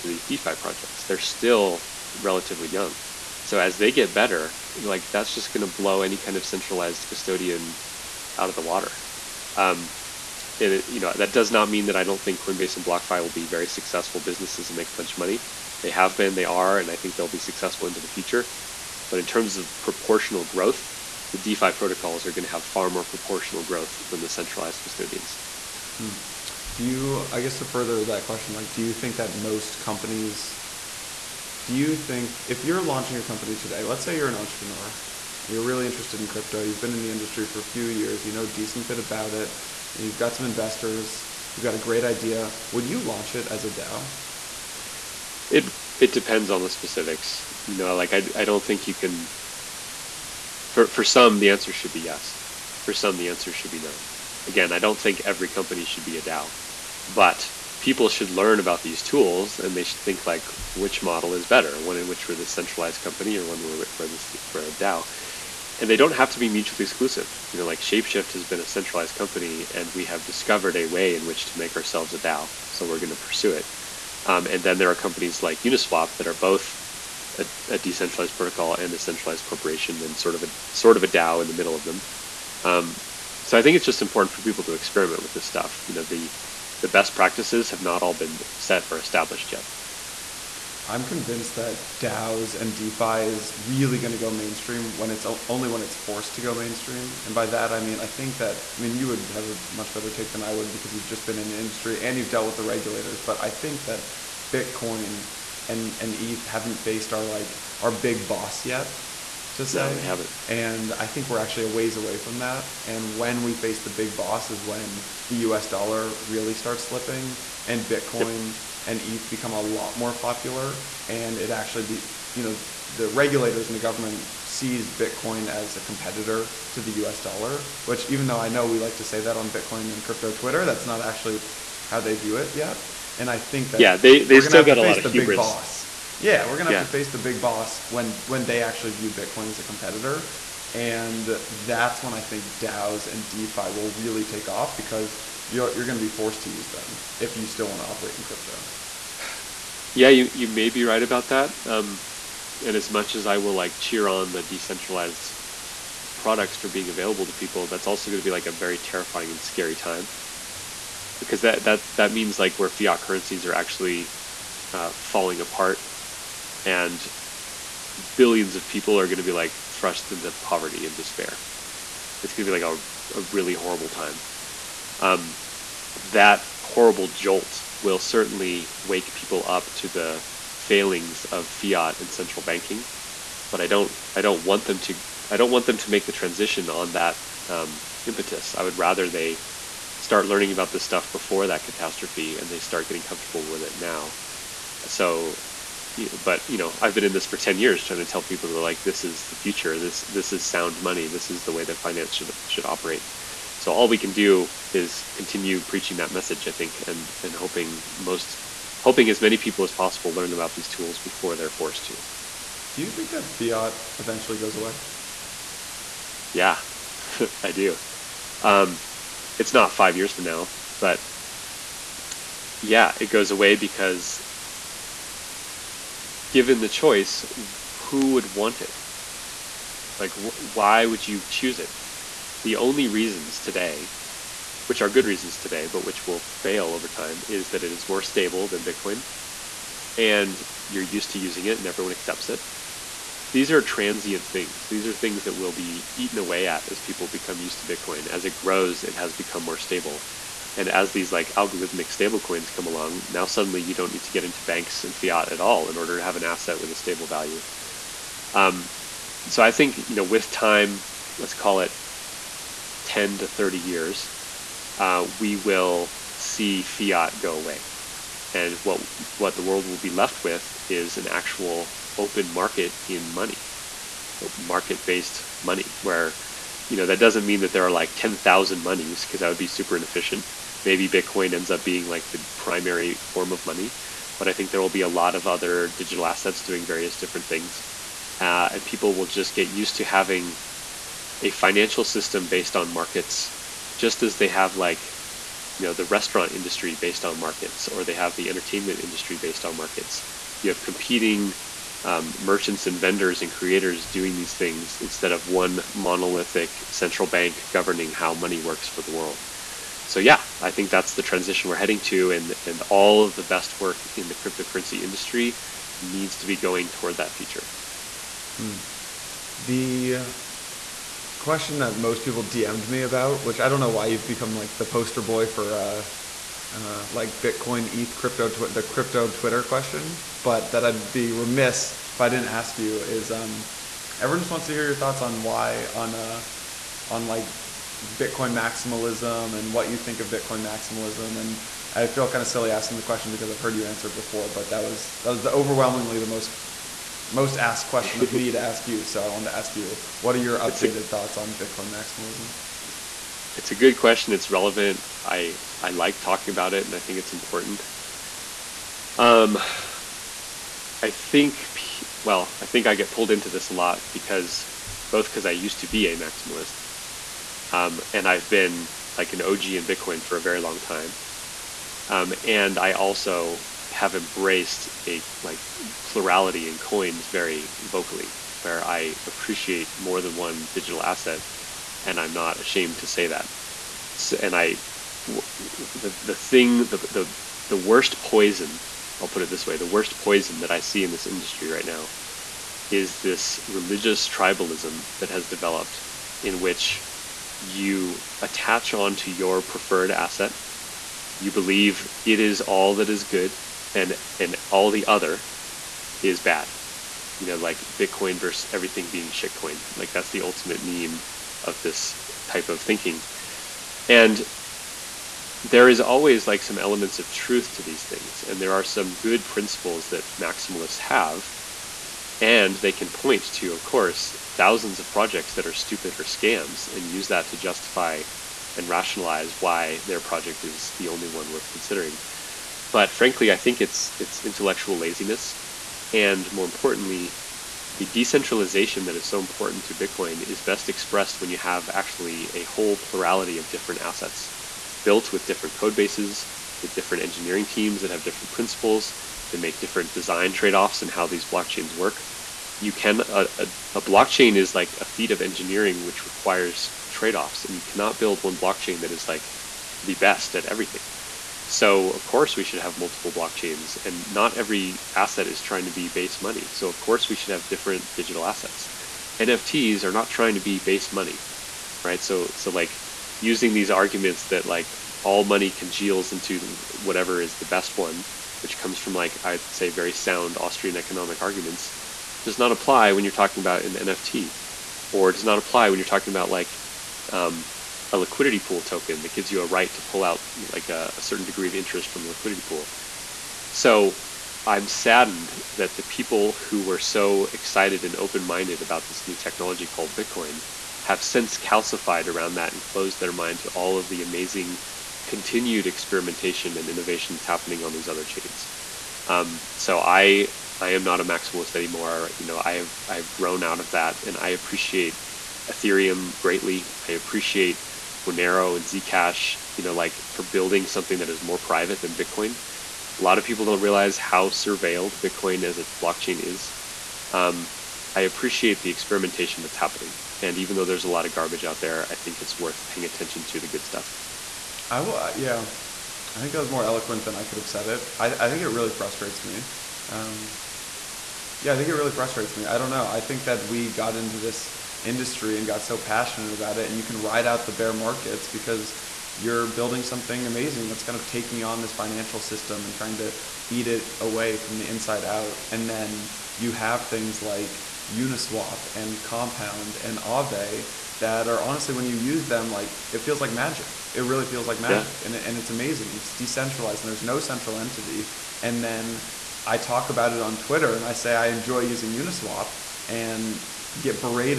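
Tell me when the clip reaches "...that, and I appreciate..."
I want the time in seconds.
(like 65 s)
513 s.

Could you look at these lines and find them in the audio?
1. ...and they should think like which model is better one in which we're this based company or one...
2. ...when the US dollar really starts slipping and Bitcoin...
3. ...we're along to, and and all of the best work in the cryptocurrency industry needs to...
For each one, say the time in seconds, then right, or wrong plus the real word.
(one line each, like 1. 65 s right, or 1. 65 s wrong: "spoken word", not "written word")
1. 59 s wrong: "centralized", not "based"
2. 114 s right
3. 311 s wrong: "heading", not "along".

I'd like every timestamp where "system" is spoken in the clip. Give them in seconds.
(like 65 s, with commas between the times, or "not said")
291 s, 552 s.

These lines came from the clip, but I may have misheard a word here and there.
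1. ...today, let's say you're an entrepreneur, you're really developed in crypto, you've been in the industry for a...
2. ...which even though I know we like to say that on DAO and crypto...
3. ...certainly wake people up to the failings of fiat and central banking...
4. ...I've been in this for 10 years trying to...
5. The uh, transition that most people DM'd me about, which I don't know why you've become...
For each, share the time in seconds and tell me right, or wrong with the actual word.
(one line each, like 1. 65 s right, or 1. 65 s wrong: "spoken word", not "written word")
1. 33 s wrong: "interested", not "developed"
2. 127 s wrong: "Bitcoin", not "DAO"
3. 177 s right
4. 196 s right
5. 319 s wrong: "question", not "transition".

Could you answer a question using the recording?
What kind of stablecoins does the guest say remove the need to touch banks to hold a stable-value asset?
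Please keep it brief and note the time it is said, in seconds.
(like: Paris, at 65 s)
algorithmic stablecoins, at 251 s.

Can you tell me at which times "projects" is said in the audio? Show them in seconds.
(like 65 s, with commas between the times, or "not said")
0 s, 424 s, 430 s.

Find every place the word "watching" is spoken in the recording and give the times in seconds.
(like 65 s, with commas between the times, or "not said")
not said.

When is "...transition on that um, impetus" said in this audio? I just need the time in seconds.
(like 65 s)
186 s.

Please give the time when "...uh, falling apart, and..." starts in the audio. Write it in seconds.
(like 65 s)
164 s.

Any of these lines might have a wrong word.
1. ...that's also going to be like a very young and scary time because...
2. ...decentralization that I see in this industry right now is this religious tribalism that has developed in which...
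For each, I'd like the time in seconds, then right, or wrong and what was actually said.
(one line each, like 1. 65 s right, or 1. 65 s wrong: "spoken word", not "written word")
1. 157 s wrong: "terrifying", not "young"
2. 389 s wrong: "poison", not "decentralization".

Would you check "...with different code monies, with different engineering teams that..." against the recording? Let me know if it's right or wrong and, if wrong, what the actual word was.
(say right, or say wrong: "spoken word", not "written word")
wrong: "bases", not "monies".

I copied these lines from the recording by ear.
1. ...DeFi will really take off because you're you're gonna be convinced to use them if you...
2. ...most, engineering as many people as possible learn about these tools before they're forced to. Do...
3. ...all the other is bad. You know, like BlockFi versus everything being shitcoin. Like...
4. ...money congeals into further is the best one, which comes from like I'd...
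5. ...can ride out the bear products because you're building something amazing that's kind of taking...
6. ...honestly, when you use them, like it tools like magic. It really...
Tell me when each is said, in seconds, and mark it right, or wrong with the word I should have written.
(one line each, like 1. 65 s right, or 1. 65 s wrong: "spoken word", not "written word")
1. 143 s wrong: "forced", not "convinced"
2. 207 s wrong: "hoping", not "engineering"
3. 404 s wrong: "Bitcoin", not "BlockFi"
4. 475 s wrong: "whatever", not "further"
5. 546 s wrong: "markets", not "products"
6. 561 s wrong: "feels", not "tools".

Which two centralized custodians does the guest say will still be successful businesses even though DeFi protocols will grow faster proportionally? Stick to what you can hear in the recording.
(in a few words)
Coinbase and BlockFi.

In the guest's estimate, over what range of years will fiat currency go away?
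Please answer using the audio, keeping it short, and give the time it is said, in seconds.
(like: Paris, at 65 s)
10 to 30 years, at 262 s.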